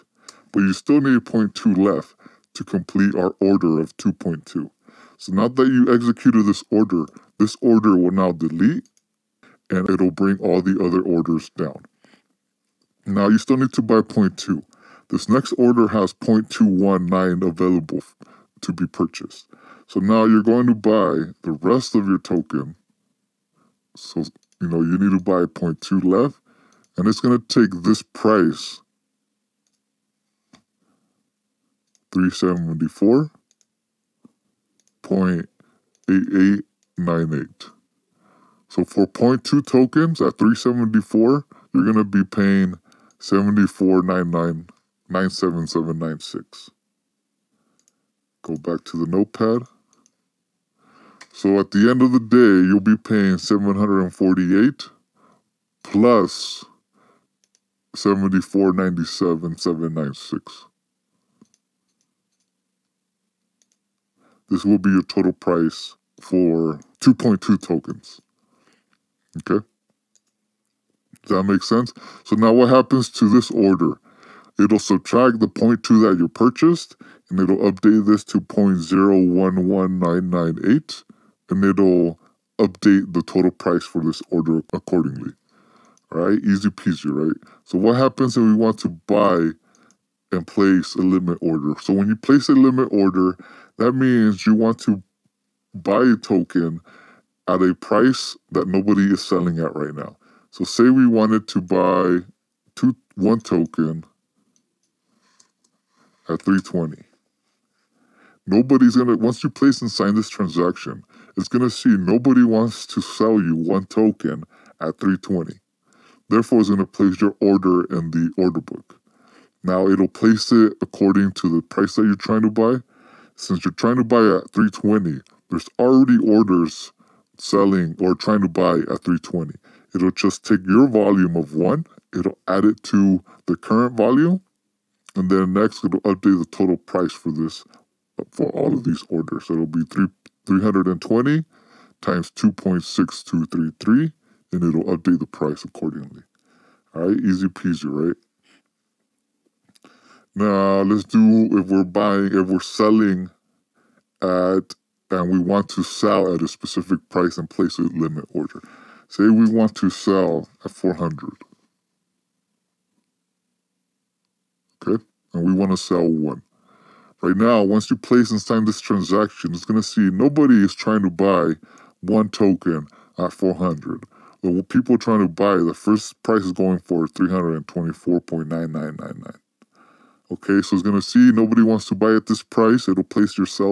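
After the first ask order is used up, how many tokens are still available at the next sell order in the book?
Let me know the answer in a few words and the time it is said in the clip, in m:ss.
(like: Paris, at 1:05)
0.219, at 0:16.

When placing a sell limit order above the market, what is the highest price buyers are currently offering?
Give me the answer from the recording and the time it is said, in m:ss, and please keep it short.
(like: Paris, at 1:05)
324.9999, at 2:57.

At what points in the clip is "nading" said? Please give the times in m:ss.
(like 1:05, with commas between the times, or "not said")
not said.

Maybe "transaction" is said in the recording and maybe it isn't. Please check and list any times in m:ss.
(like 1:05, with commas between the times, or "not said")
1:50, 2:48.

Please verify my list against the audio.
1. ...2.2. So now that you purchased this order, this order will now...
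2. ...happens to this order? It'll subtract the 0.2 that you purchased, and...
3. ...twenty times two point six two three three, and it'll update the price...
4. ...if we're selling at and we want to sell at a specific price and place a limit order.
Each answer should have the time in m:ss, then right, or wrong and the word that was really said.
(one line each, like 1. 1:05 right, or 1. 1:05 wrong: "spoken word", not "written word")
1. 0:03 wrong: "executed", not "purchased"
2. 1:12 right
3. 2:21 right
4. 2:32 right.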